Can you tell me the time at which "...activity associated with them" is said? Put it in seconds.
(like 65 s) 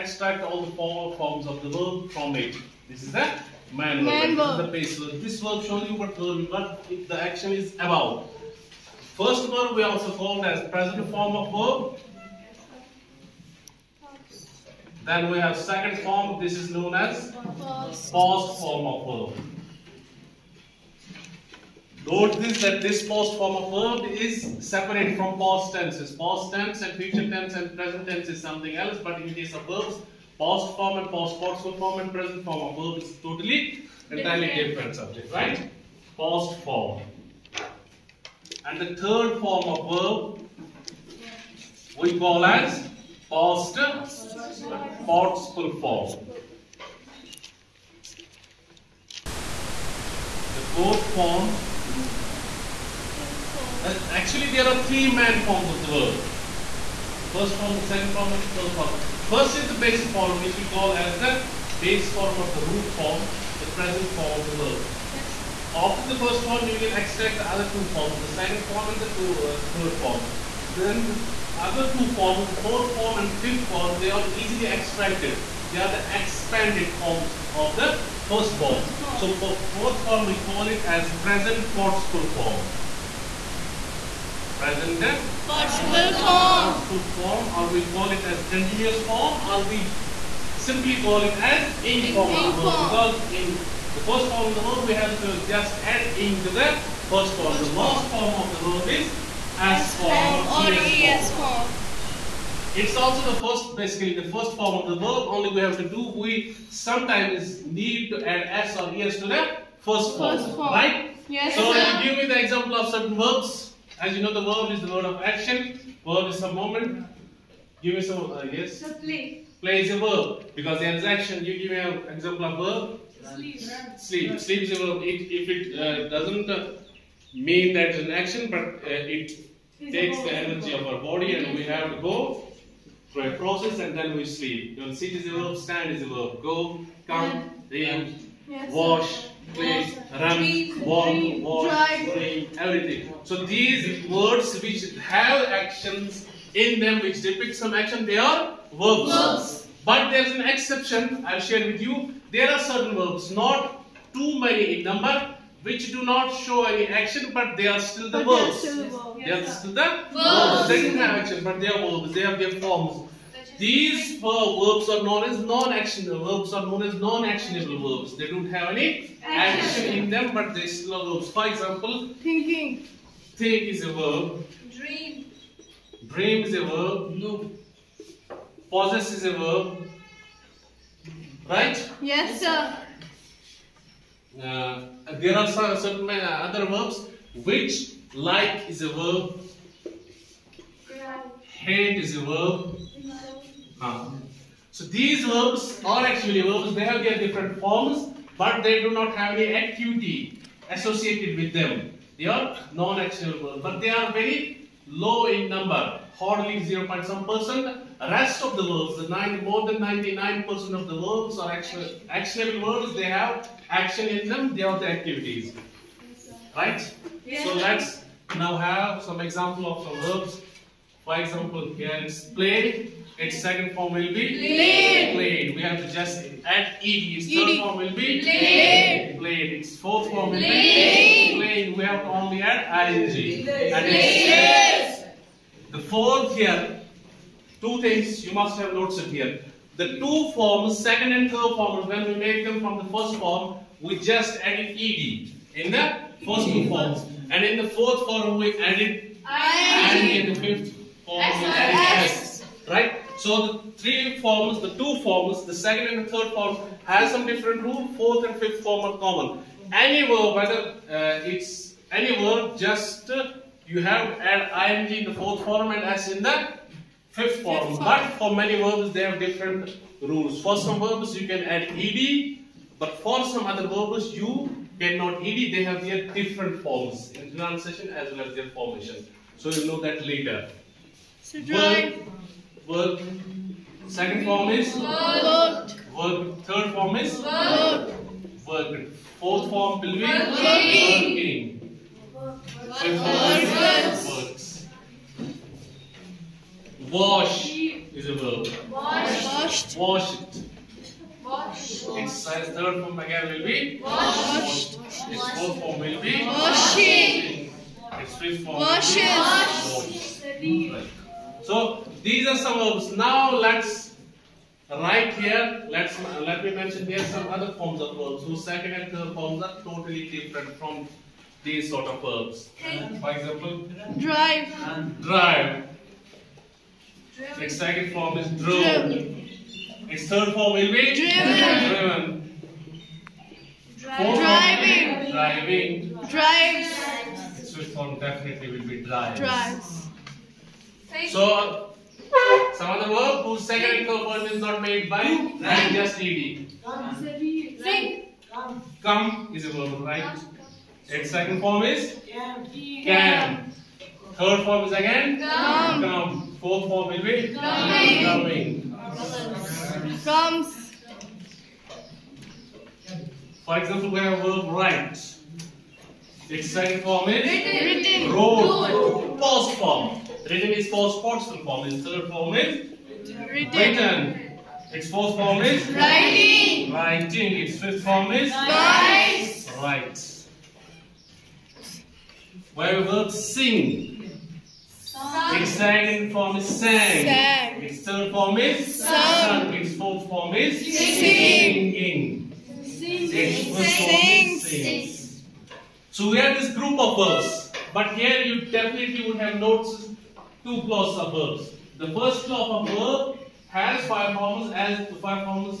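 199 s.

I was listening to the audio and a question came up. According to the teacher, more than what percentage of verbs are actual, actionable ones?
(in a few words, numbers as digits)
99%.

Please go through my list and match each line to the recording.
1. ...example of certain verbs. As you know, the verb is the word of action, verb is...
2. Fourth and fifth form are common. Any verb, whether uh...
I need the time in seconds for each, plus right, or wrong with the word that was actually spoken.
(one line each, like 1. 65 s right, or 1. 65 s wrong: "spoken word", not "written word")
1. 112 s right
2. 257 s right.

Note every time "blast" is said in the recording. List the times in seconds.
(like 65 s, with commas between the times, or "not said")
not said.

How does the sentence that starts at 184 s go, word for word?
Uh, there are some certain uh, other verbs which like is a verb.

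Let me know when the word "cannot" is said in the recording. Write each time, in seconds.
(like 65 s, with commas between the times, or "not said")
274 s.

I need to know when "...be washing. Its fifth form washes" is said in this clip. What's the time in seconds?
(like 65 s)
306 s.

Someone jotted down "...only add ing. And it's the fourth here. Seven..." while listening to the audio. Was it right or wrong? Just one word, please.
wrong.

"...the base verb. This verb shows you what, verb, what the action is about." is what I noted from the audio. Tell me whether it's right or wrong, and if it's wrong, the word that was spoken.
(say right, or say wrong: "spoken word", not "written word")
right.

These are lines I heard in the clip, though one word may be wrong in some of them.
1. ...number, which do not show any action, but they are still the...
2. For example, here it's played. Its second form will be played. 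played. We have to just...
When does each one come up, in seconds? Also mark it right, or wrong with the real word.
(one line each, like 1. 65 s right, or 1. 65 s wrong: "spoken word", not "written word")
1. 154 s right
2. 221 s right.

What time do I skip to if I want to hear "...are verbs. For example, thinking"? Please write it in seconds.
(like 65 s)
170 s.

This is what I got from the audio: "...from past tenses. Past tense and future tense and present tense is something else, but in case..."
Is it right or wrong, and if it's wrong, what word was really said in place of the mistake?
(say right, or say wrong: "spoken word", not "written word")
right.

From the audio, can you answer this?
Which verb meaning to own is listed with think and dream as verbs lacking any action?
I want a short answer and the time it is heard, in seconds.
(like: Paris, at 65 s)
Possess, at 178 s.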